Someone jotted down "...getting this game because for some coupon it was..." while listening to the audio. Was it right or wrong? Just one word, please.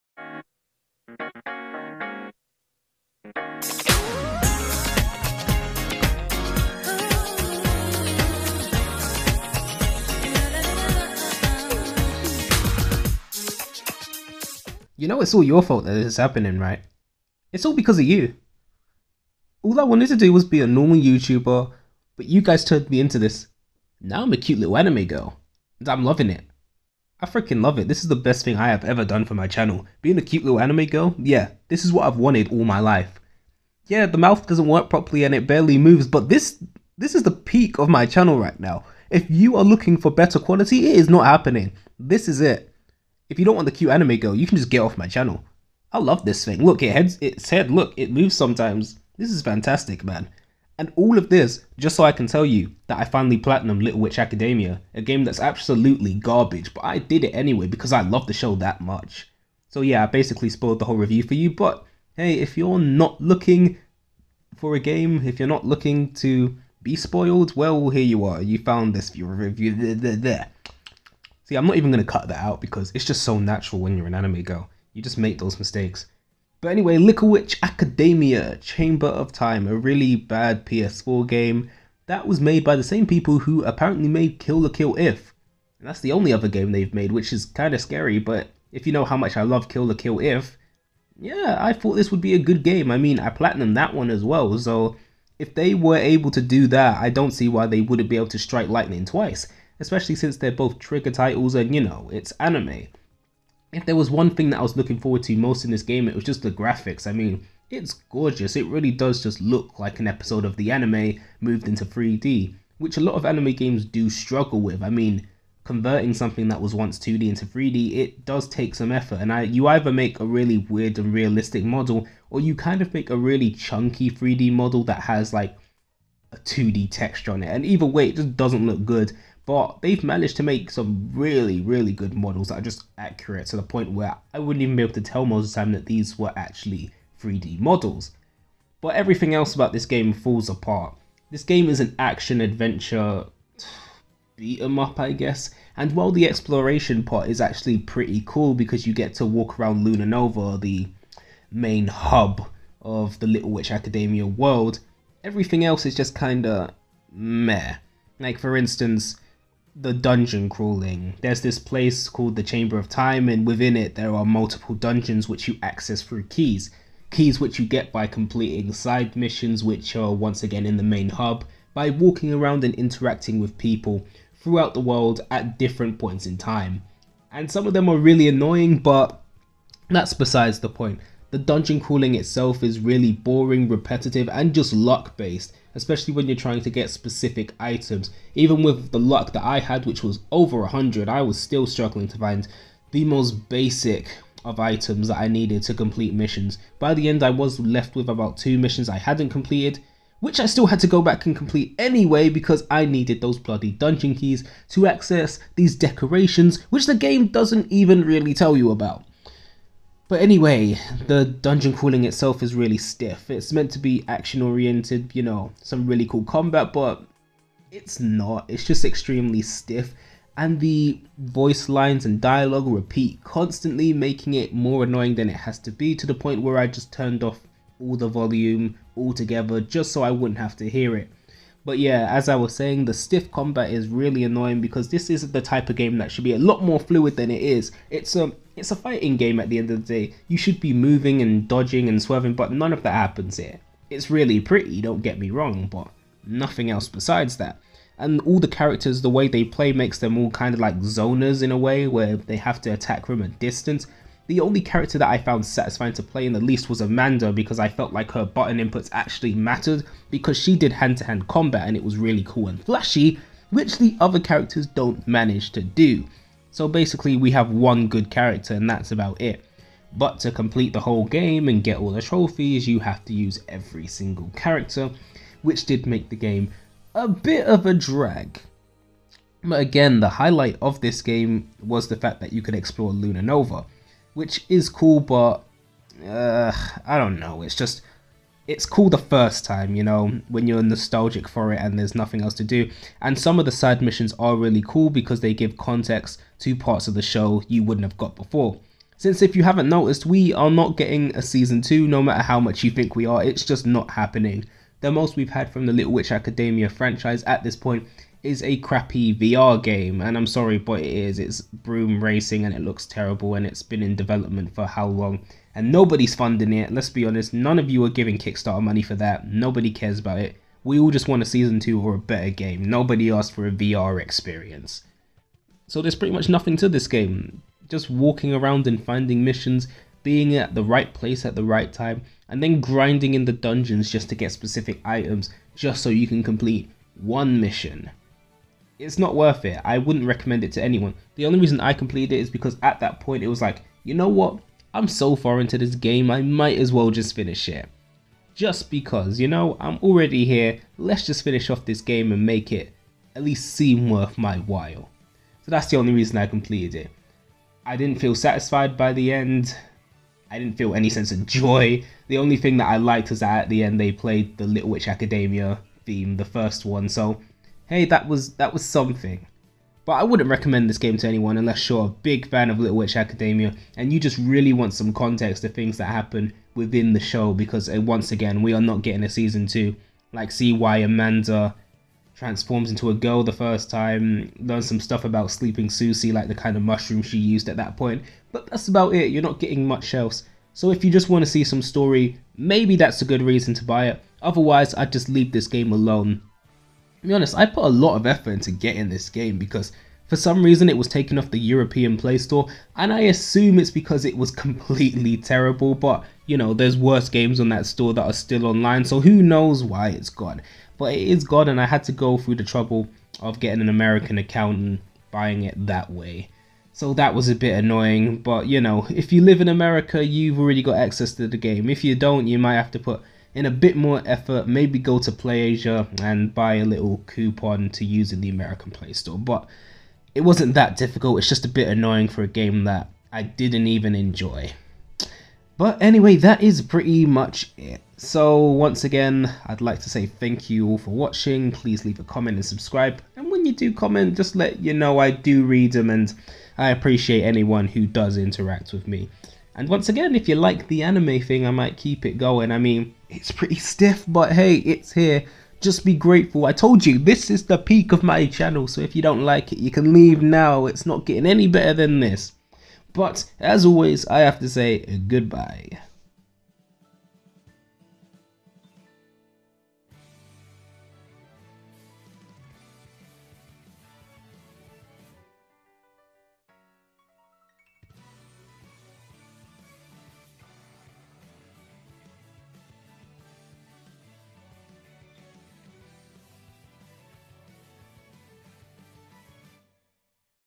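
wrong.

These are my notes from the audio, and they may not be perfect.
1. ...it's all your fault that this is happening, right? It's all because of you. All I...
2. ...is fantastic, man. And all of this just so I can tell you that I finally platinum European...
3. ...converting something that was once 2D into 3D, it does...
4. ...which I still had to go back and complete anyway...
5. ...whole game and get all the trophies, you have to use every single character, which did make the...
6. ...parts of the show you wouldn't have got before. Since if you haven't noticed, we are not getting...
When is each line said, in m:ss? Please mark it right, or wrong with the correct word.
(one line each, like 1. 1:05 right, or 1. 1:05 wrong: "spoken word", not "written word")
1. 0:15 right
2. 0:49 wrong: "Little", not "European"
3. 1:55 right
4. 3:20 right
5. 4:30 right
6. 4:56 right.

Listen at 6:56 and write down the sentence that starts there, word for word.
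So that was a bit annoying, but you know, if you live in America, you've already got access to the game.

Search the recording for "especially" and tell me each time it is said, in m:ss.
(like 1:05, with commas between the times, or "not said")
1:39, 3:05.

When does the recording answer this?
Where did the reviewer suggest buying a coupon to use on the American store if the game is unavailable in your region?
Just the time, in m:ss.
7:05.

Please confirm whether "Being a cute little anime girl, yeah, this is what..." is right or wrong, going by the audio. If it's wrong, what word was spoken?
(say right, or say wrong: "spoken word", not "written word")
right.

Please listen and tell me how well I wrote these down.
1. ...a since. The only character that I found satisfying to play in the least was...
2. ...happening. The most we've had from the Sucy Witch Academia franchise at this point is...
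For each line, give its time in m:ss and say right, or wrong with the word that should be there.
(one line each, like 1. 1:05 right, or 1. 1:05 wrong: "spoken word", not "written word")
1. 4:13 wrong: "distance", not "since"
2. 5:03 wrong: "Little", not "Sucy".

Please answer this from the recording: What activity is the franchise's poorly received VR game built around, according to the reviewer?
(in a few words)
Broom racing.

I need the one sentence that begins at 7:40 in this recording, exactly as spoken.
It's not getting any better than this.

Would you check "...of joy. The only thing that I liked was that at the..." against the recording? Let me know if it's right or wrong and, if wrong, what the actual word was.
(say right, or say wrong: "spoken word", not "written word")
right.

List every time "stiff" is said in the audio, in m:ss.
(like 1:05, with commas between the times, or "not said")
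3:32, 3:39, 3:52, 7:33.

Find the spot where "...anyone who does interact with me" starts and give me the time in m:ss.
7:27.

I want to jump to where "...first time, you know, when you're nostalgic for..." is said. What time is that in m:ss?
4:48.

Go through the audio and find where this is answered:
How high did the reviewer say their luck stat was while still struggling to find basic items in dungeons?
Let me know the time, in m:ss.
3:10.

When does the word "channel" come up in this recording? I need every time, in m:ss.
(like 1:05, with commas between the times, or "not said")
0:29, 0:38, 0:45, 7:38.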